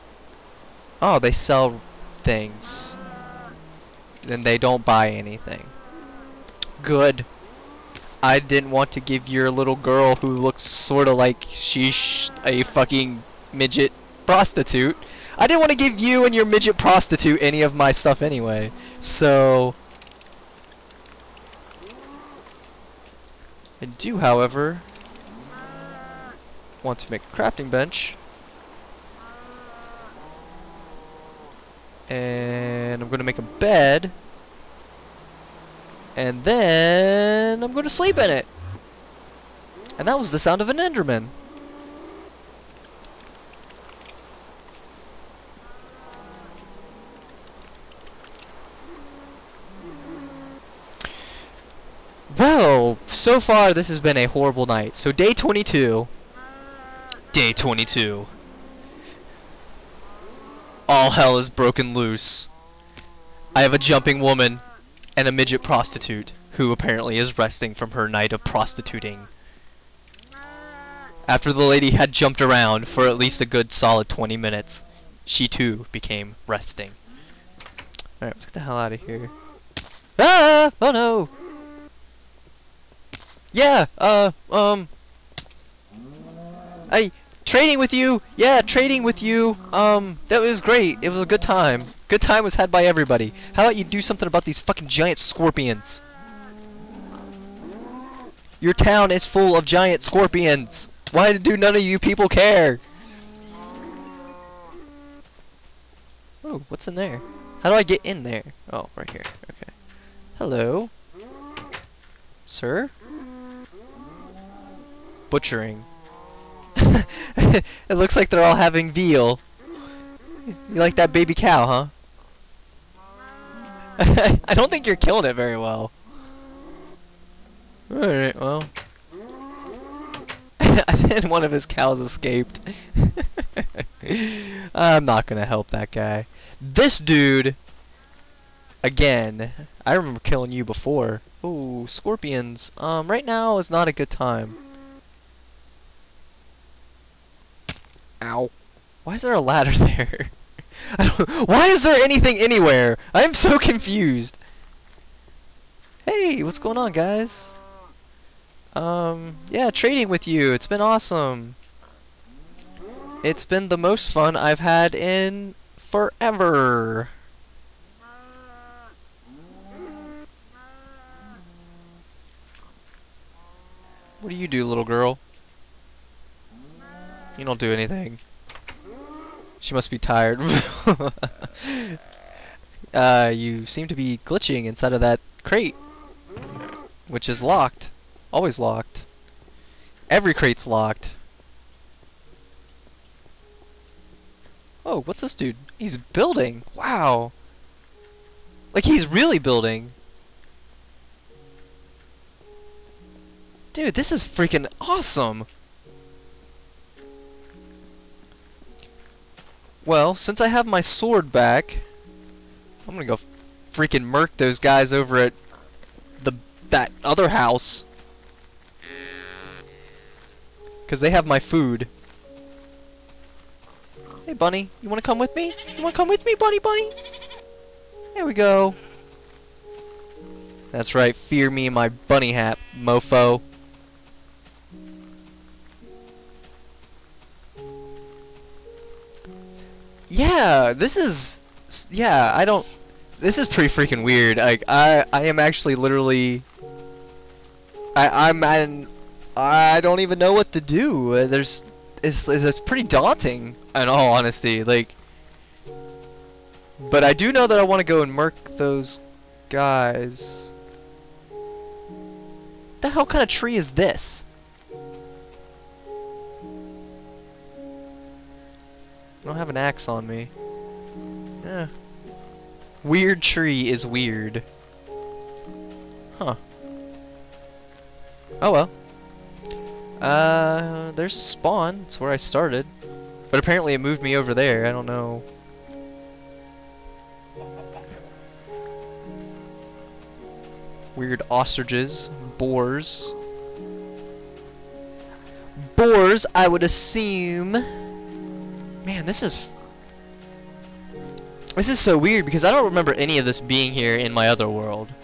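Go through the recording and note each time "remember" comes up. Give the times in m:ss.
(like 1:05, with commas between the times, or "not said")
2:19, 5:02.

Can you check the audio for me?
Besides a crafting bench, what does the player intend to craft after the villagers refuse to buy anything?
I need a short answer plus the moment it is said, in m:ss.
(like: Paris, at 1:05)
A bed, at 0:33.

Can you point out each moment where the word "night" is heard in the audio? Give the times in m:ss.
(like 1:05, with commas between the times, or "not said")
0:54, 1:08.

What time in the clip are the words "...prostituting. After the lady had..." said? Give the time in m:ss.
1:08.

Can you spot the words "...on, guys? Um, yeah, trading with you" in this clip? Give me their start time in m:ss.
2:36.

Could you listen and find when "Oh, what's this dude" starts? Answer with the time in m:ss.
3:14.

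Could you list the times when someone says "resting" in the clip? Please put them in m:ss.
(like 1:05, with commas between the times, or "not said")
1:07, 1:16.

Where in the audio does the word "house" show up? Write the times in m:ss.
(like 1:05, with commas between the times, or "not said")
3:37.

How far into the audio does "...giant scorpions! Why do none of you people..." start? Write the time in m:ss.
1:39.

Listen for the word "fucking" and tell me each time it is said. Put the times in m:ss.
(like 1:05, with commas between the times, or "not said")
0:12, 1:34.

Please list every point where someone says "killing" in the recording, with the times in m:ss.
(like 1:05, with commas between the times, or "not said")
2:04, 2:20.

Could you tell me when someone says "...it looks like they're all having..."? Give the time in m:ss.
1:56.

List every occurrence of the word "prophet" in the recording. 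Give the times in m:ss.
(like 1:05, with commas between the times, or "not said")
not said.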